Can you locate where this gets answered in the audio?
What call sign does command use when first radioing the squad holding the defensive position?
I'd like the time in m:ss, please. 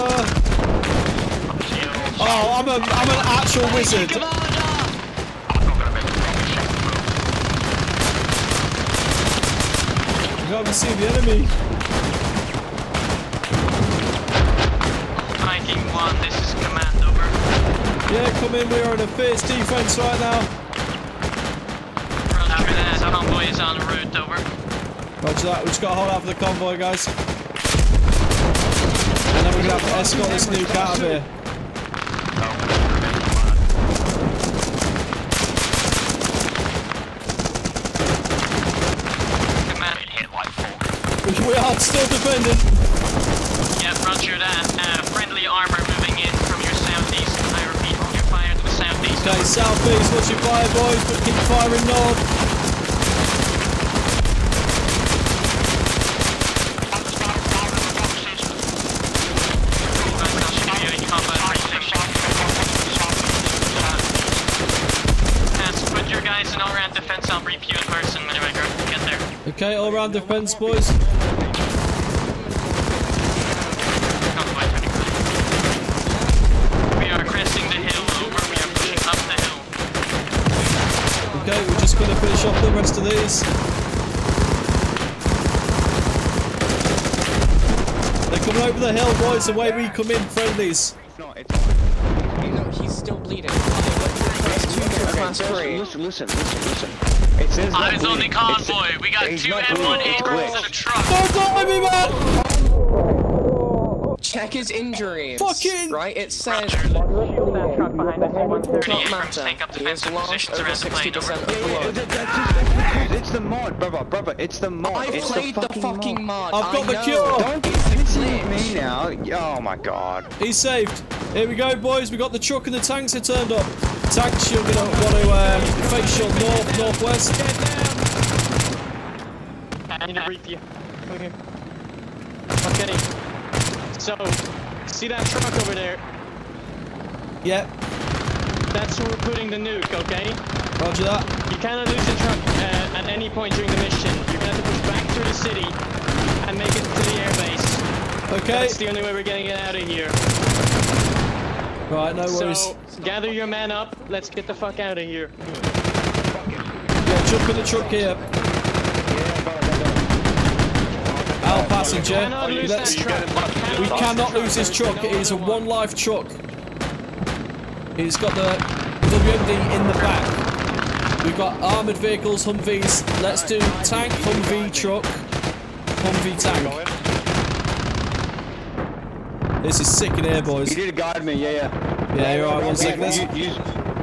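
0:15.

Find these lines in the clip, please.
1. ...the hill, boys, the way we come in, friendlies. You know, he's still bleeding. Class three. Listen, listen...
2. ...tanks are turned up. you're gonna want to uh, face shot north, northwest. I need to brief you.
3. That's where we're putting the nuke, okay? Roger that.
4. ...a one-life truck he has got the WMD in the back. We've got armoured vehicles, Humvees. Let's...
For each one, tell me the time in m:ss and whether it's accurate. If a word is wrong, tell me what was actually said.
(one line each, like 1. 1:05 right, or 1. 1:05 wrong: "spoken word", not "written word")
1. 1:28 right
2. 2:02 right
3. 2:18 right
4. 2:45 right.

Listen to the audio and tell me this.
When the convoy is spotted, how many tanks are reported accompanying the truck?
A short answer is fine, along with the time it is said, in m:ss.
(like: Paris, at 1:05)
2, at 1:39.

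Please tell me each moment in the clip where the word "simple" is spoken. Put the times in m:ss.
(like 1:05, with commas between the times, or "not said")
not said.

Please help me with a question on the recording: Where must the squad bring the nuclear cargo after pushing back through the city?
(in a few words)
the airbase.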